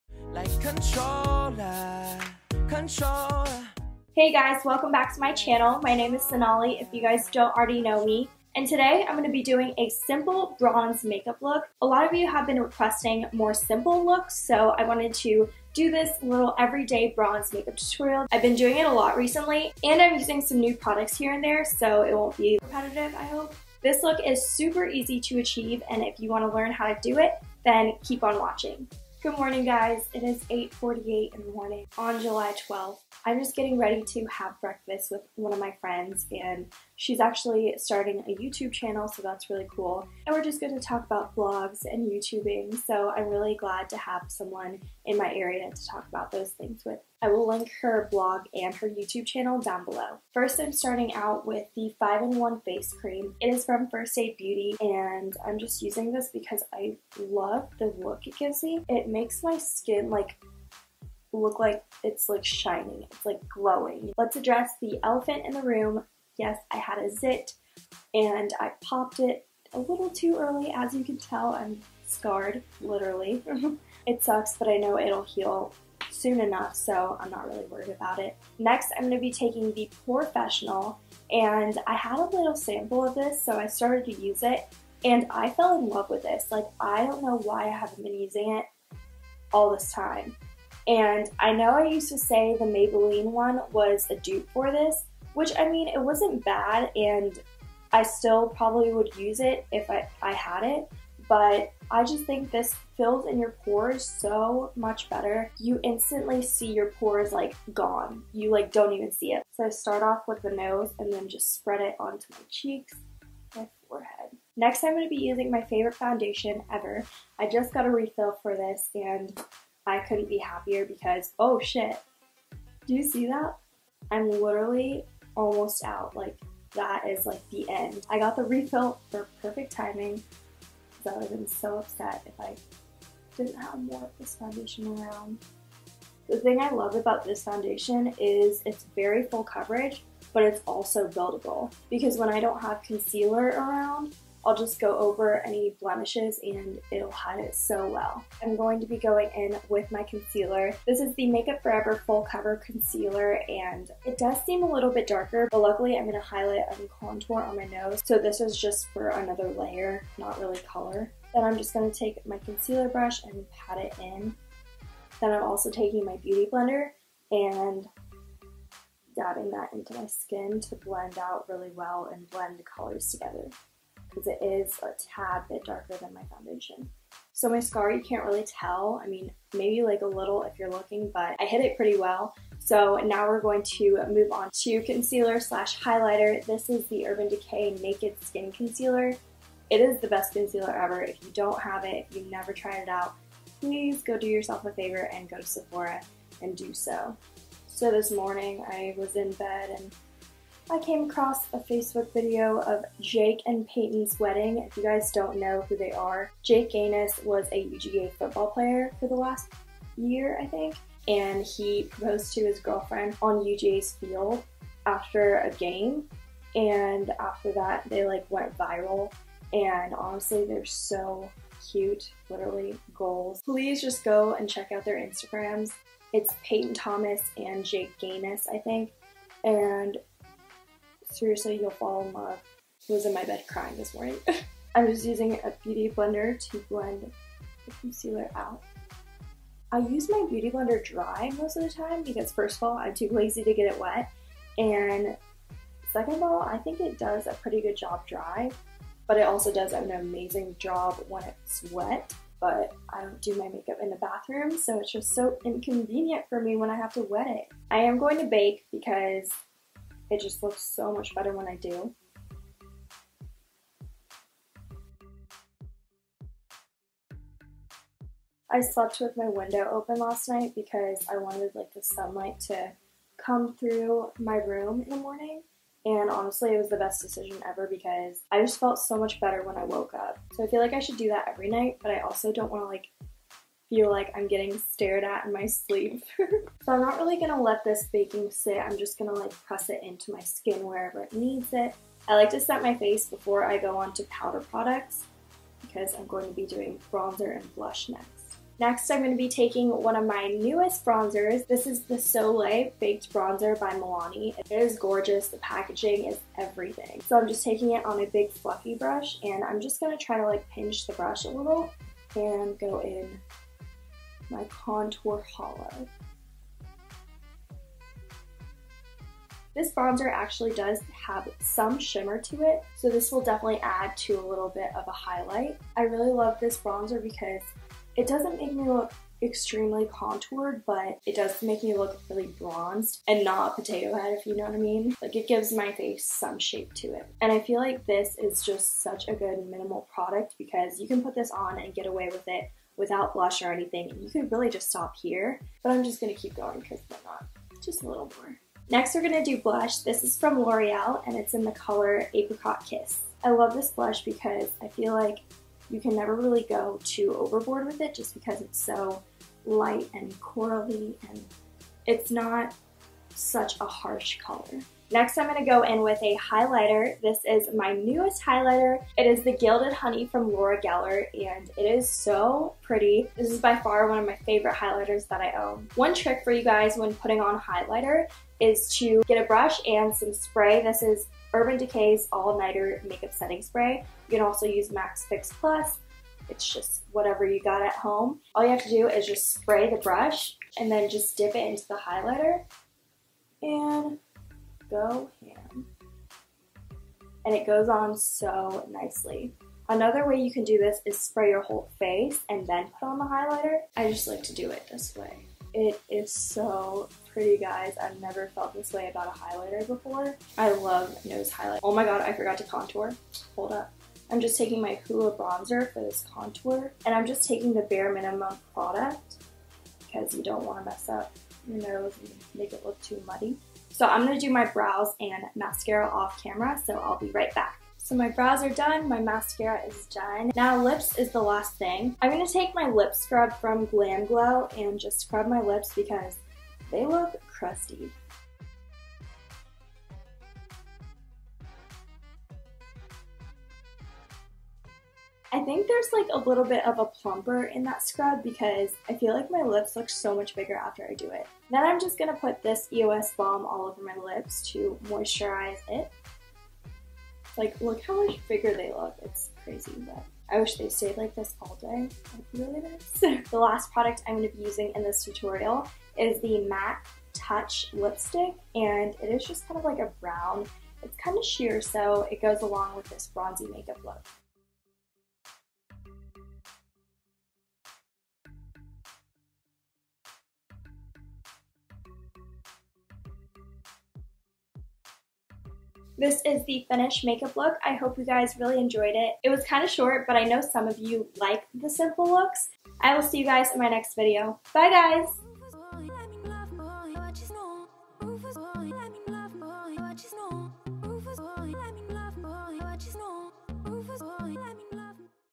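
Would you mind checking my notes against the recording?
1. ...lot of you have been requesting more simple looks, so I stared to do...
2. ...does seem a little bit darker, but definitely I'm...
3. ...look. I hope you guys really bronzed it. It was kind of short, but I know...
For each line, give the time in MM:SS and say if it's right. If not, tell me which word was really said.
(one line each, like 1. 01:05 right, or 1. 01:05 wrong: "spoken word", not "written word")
1. 00:11 wrong: "wanted", not "stared"
2. 02:34 wrong: "luckily", not "definitely"
3. 08:07 wrong: "enjoyed", not "bronzed".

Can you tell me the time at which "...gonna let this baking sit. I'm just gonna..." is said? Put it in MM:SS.
04:47.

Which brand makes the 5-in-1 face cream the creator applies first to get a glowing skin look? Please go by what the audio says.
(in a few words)
First Aid Beauty.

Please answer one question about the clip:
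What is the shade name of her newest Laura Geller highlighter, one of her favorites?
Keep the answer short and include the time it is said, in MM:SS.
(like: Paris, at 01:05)
Gilded Honey, at 06:09.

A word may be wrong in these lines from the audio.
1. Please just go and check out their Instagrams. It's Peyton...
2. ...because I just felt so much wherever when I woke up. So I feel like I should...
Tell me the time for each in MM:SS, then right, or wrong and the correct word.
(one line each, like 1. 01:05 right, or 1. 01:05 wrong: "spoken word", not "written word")
1. 03:43 right
2. 04:37 wrong: "better", not "wherever".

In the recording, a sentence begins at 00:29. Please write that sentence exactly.
Good morning guys, it is 8.48 in the morning on July 12th.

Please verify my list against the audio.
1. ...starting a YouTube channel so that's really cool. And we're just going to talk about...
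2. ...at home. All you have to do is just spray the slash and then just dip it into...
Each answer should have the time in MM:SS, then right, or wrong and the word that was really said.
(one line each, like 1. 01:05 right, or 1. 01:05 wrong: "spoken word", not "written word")
1. 00:37 right
2. 06:27 wrong: "brush", not "slash".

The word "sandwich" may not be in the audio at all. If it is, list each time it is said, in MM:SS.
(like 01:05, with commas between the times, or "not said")
not said.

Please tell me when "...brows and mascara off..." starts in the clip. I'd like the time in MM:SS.
07:04.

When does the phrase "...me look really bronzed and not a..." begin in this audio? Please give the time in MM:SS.
05:31.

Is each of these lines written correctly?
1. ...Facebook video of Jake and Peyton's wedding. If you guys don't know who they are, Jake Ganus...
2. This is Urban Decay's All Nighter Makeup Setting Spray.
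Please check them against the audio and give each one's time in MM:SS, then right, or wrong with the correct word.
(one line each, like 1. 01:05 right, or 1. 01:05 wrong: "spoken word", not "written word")
1. 03:21 right
2. 06:20 right.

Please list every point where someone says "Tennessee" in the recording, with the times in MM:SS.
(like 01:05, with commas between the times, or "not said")
not said.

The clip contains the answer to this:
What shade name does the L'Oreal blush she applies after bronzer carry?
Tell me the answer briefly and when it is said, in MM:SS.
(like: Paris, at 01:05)
Apricot Kiss, at 05:52.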